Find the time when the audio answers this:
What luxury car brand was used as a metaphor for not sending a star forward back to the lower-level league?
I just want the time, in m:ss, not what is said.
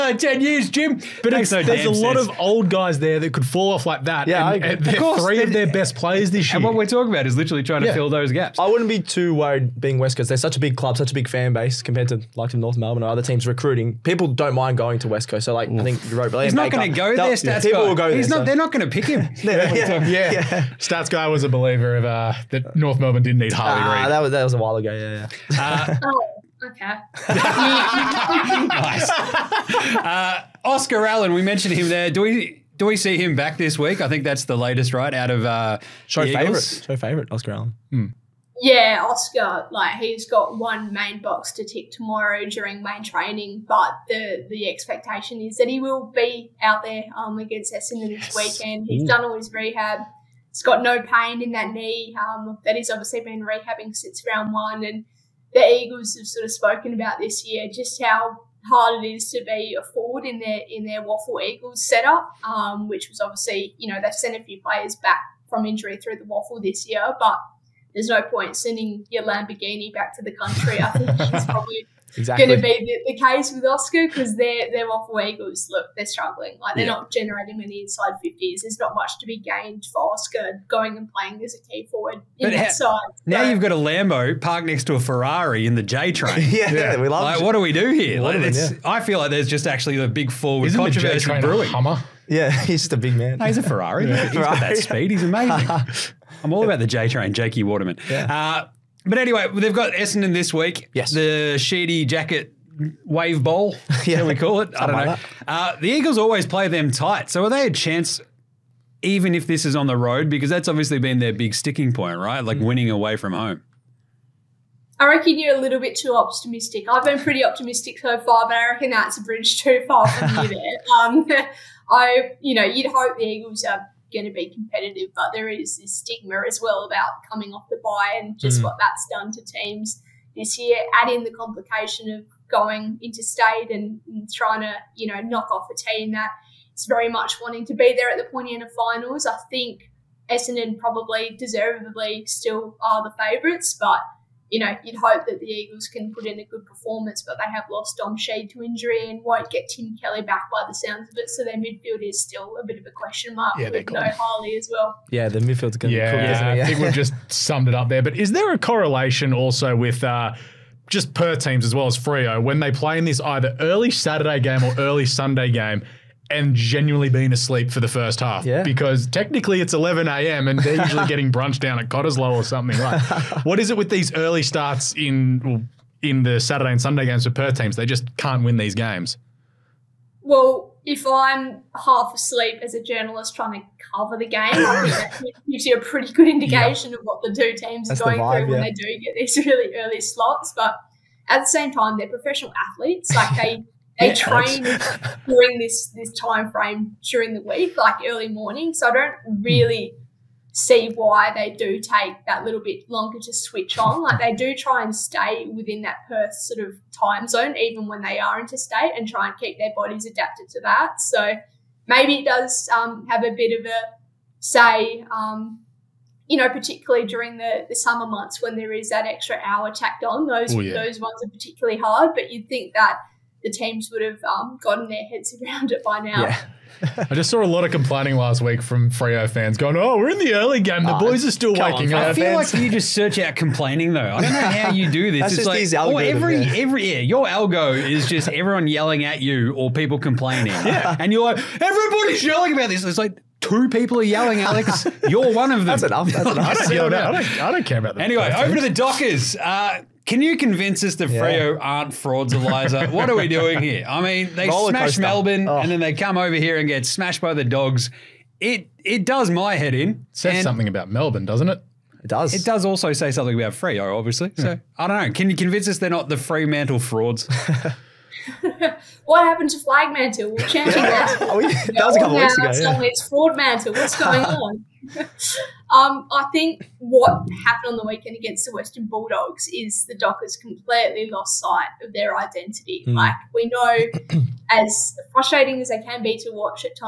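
1:09.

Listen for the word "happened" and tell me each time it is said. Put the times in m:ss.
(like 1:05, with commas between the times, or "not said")
4:29, 4:37.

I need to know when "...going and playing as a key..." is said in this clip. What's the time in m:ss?
1:20.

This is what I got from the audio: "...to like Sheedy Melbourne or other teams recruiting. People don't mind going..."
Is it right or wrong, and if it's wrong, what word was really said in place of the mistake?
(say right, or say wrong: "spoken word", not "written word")
wrong: "North", not "Sheedy".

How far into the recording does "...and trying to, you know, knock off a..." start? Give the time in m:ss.
2:14.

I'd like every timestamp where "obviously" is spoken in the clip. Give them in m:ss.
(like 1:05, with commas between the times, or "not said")
0:52, 1:03, 1:50, 4:23.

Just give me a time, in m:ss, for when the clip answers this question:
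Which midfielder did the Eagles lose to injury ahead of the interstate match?
2:27.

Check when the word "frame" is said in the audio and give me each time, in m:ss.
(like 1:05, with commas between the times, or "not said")
3:16.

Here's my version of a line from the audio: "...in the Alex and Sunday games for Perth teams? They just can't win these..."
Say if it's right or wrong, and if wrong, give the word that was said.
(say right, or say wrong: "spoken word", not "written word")
wrong: "Saturday", not "Alex".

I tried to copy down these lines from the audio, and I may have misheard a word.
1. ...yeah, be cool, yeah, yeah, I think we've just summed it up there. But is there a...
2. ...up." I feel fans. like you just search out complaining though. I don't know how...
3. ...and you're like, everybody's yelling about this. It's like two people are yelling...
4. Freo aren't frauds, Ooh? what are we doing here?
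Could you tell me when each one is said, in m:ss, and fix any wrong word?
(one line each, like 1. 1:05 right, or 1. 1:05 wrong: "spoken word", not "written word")
1. 2:35 right
2. 3:52 right
3. 4:01 right
4. 4:11 wrong: "Eliza", not "Ooh".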